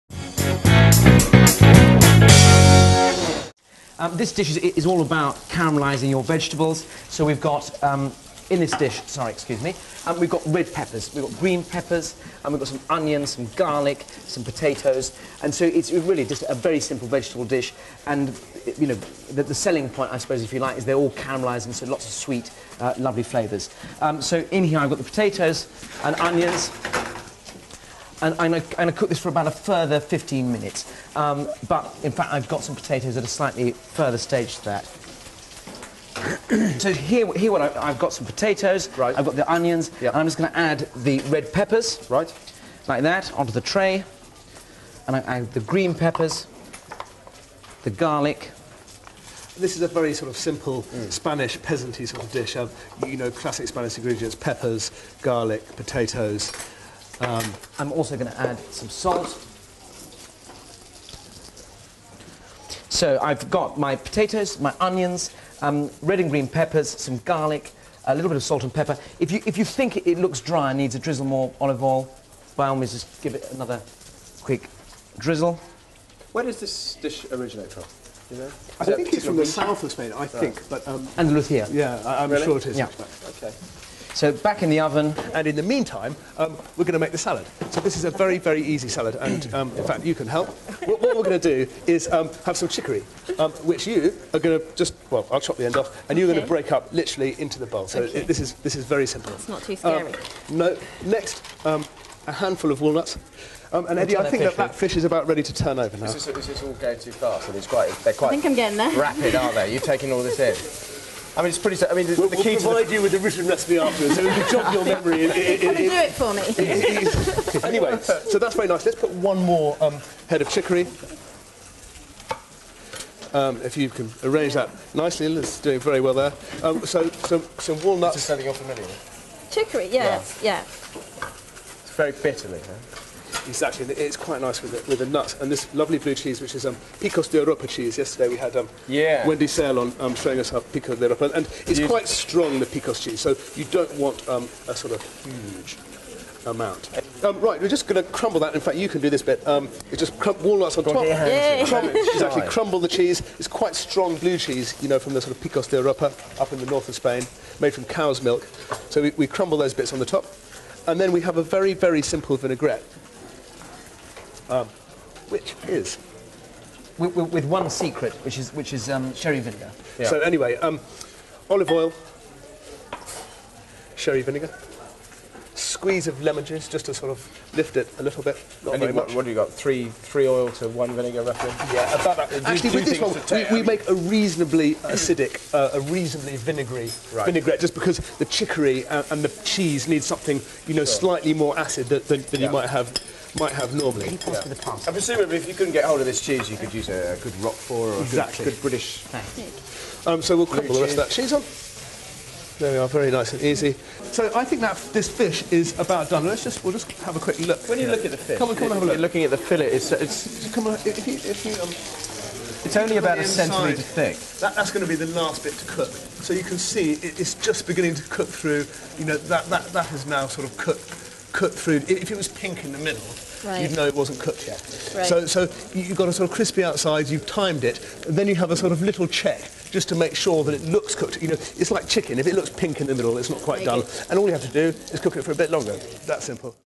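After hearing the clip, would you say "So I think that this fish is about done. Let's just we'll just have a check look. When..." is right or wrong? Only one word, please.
wrong.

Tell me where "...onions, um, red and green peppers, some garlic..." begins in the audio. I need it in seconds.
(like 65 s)
64 s.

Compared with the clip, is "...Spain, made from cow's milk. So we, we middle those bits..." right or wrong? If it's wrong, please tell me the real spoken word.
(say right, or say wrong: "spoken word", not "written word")
wrong: "crumble", not "middle".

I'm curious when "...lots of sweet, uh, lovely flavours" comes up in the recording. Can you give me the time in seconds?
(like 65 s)
21 s.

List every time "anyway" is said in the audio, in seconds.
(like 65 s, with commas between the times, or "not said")
117 s, 170 s.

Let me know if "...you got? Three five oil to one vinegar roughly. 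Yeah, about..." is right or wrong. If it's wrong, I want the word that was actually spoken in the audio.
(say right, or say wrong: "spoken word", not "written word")
wrong: "three", not "five".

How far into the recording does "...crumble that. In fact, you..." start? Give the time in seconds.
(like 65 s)
148 s.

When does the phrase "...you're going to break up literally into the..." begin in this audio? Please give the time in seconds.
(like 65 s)
96 s.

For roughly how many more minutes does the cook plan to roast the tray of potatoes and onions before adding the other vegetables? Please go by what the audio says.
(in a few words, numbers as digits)
15 minutes.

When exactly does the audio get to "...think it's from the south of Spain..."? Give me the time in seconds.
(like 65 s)
78 s.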